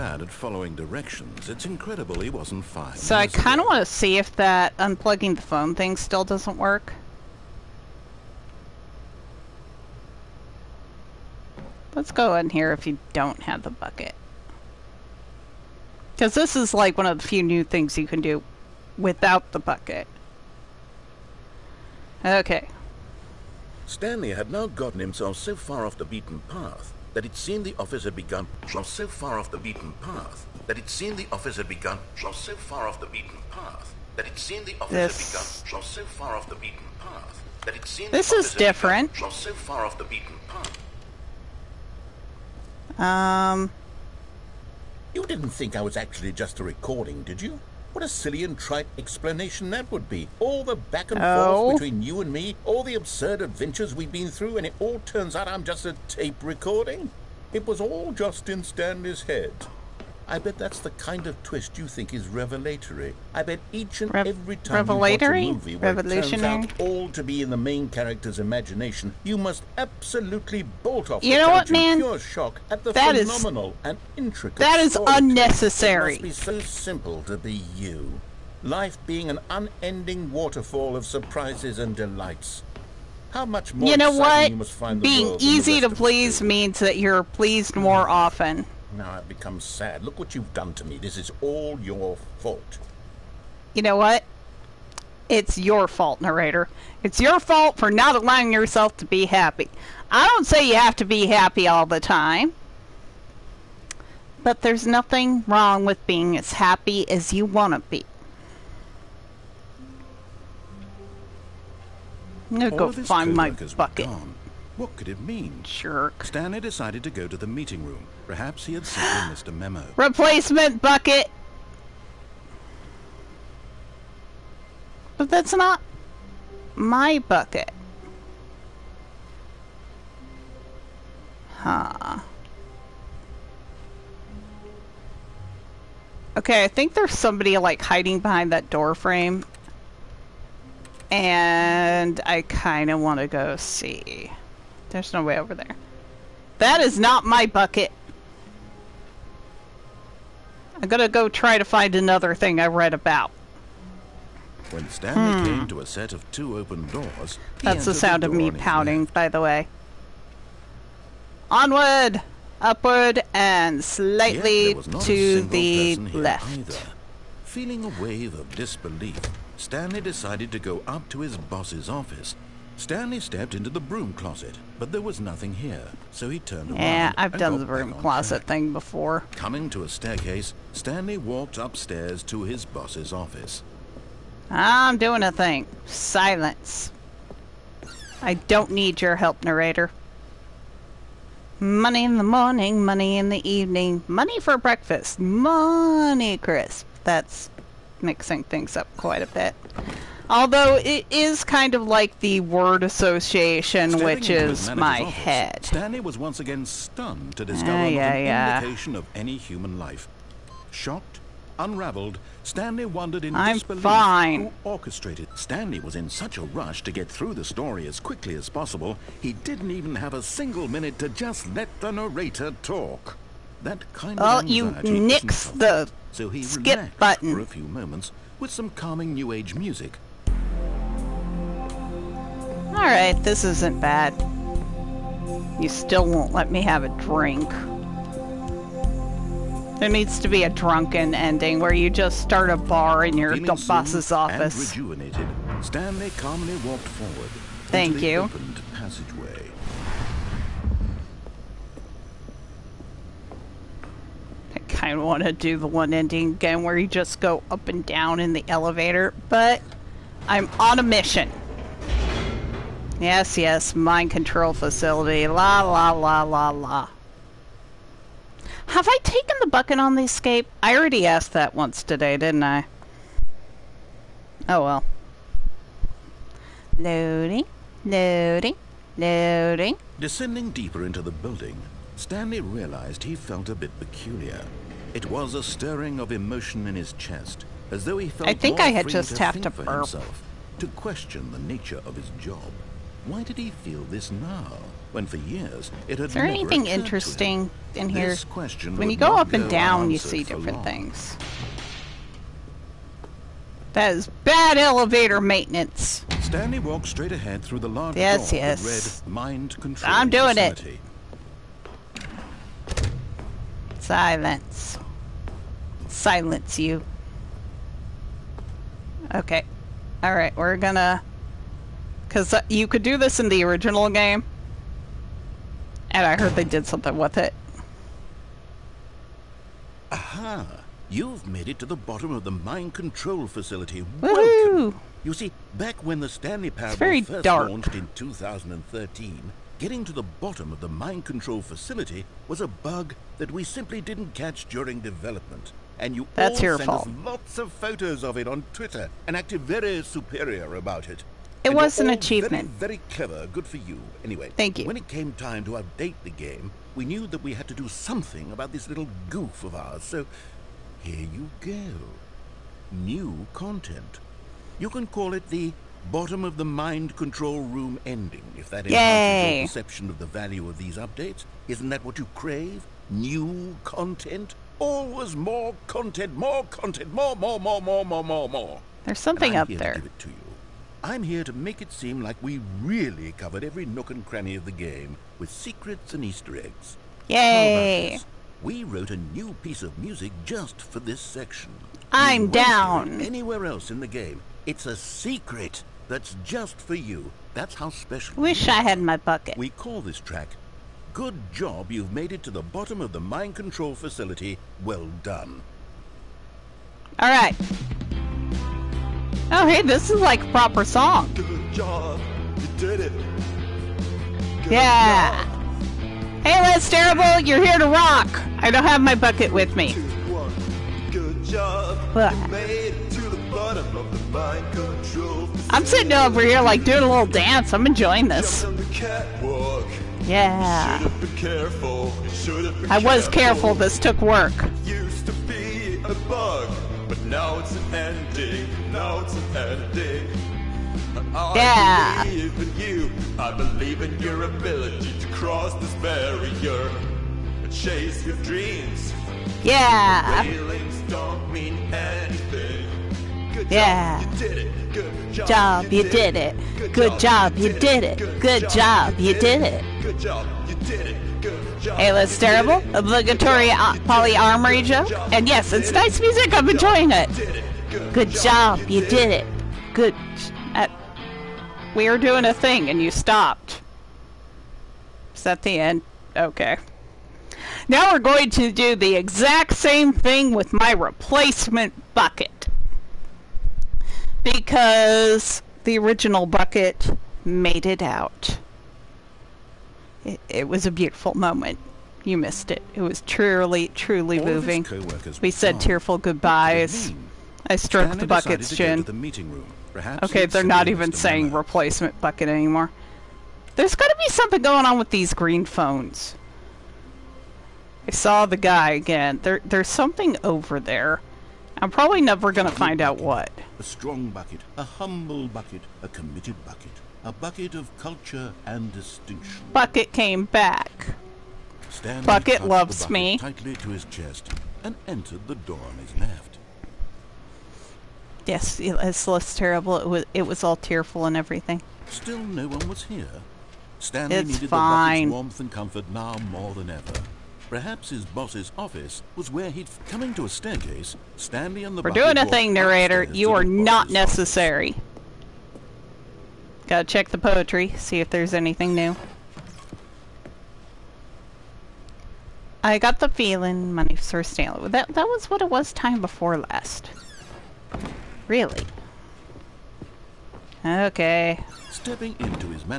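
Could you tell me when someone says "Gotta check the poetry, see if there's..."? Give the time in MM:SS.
09:06.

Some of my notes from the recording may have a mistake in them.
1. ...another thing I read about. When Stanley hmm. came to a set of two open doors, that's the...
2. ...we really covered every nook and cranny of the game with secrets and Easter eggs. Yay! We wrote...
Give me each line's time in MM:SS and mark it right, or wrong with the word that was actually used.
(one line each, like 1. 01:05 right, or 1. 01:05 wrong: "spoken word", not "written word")
1. 02:31 right
2. 06:22 right.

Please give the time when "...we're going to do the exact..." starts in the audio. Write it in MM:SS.
07:57.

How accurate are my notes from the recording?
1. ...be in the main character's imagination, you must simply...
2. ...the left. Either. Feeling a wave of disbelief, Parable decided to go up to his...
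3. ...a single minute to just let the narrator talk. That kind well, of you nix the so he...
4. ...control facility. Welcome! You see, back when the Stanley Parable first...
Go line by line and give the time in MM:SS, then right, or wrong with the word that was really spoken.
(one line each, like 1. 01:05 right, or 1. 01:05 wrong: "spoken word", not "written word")
1. 01:07 wrong: "absolutely", not "simply"
2. 02:45 wrong: "Stanley", not "Parable"
3. 03:40 right
4. 05:32 right.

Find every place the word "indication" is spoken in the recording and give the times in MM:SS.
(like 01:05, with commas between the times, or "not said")
03:28.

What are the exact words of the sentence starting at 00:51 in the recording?
forth between you and me, all the absurd adventures we've been through, and it all turns out I'm just a tape recording.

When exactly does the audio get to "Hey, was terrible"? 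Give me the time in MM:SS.
07:41.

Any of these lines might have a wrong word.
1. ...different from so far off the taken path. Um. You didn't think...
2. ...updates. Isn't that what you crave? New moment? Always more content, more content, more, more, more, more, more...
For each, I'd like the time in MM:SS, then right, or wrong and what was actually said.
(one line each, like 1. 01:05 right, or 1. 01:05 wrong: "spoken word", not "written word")
1. 00:38 wrong: "beaten", not "taken"
2. 06:10 wrong: "content", not "moment".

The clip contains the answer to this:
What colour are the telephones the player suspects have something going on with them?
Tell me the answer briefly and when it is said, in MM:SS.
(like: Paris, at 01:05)
green, at 08:25.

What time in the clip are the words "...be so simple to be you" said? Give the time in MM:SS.
01:16.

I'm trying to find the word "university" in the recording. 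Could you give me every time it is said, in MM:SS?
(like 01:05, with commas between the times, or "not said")
not said.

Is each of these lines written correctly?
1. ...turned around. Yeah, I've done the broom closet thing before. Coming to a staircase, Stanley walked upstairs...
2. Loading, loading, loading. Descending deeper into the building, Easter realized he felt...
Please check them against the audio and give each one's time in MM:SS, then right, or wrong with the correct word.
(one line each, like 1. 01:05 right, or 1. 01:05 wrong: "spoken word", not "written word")
1. 02:56 right
2. 04:36 wrong: "Stanley", not "Easter".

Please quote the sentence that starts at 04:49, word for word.
Himself, to question the nature of his job.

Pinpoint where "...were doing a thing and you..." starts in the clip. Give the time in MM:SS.
07:51.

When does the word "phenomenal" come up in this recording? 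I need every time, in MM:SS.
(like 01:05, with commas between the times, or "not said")
01:13.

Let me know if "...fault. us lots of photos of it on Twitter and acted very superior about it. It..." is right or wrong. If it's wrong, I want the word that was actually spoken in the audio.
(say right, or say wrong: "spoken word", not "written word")
right.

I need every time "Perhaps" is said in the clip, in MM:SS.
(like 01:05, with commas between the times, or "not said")
01:58, 08:57.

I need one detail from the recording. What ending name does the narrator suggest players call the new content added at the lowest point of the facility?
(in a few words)
bottom of the mind control room ending.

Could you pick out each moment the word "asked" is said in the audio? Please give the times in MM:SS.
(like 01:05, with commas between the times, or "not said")
04:31.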